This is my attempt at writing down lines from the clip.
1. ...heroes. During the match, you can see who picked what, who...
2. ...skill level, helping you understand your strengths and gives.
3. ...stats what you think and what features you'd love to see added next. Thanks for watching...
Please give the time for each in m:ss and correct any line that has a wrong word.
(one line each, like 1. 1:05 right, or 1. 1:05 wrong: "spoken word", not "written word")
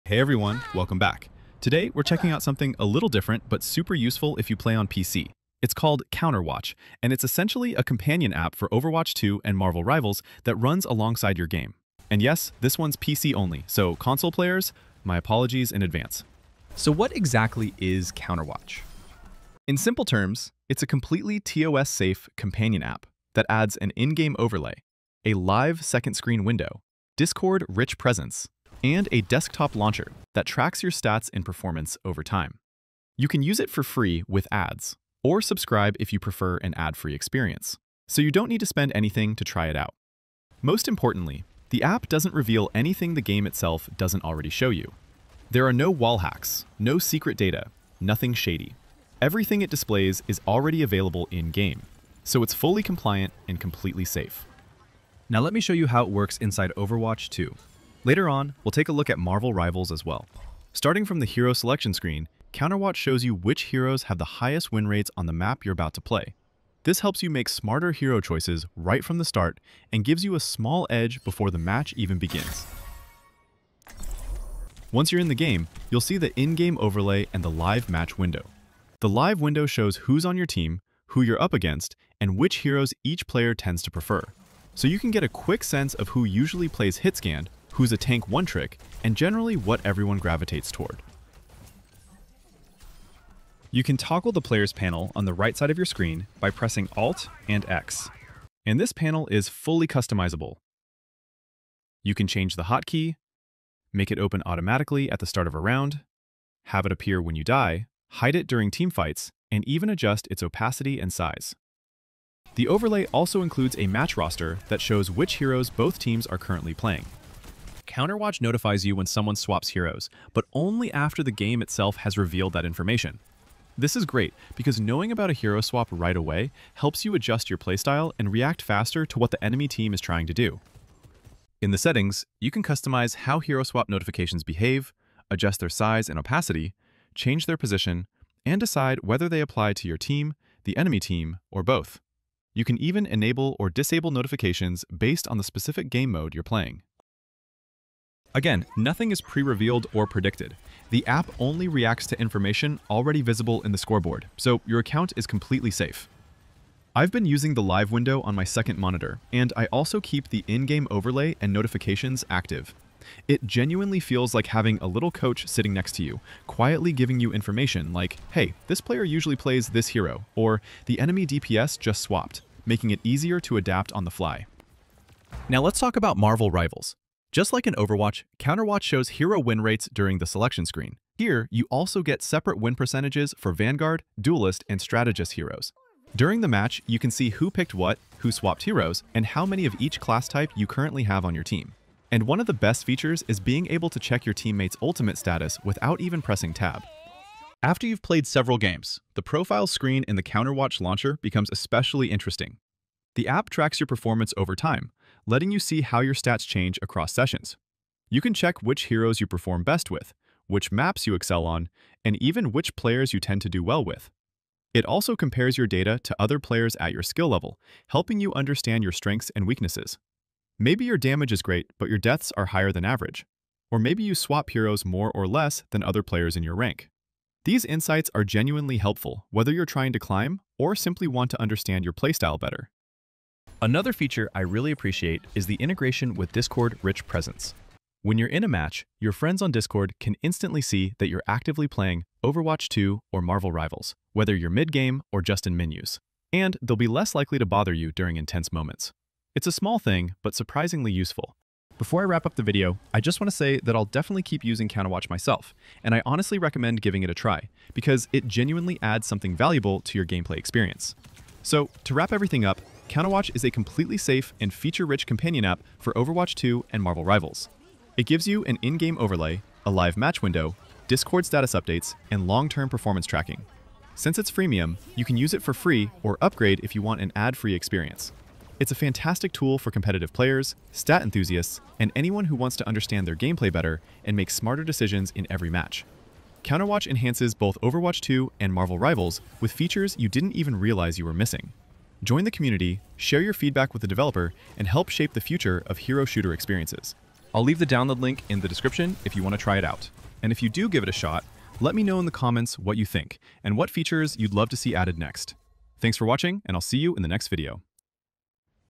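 1. 3:05 right
2. 3:37 wrong: "weaknesses", not "gives"
3. 5:02 wrong: "comments", not "stats".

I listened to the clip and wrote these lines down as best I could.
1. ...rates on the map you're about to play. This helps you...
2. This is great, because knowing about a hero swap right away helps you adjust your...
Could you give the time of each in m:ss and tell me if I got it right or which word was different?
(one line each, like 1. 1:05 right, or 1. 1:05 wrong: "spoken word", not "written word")
1. 1:04 right
2. 2:03 right.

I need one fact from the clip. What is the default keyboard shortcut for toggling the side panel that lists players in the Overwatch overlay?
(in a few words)
Alt and X.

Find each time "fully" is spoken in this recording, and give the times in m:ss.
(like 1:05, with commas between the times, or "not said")
0:52, 1:39.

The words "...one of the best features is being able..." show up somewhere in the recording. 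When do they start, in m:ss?
3:12.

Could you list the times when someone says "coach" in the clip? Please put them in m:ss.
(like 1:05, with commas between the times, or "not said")
2:45.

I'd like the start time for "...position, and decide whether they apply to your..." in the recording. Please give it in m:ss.
2:17.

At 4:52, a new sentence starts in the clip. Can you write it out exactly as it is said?
Join the community, share your feedback with the developer, and help shape the future of hero shooter experiences.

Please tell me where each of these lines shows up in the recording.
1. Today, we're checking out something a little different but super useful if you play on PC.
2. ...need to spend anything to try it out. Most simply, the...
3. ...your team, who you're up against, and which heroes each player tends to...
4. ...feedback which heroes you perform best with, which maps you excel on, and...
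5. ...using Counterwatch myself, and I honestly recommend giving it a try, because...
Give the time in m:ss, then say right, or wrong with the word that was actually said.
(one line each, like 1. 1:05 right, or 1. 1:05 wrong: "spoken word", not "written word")
1. 0:01 right
2. 0:38 wrong: "importantly", not "simply"
3. 1:20 right
4. 3:28 wrong: "check", not "feedback"
5. 4:14 right.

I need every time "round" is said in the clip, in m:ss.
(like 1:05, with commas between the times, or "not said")
1:45.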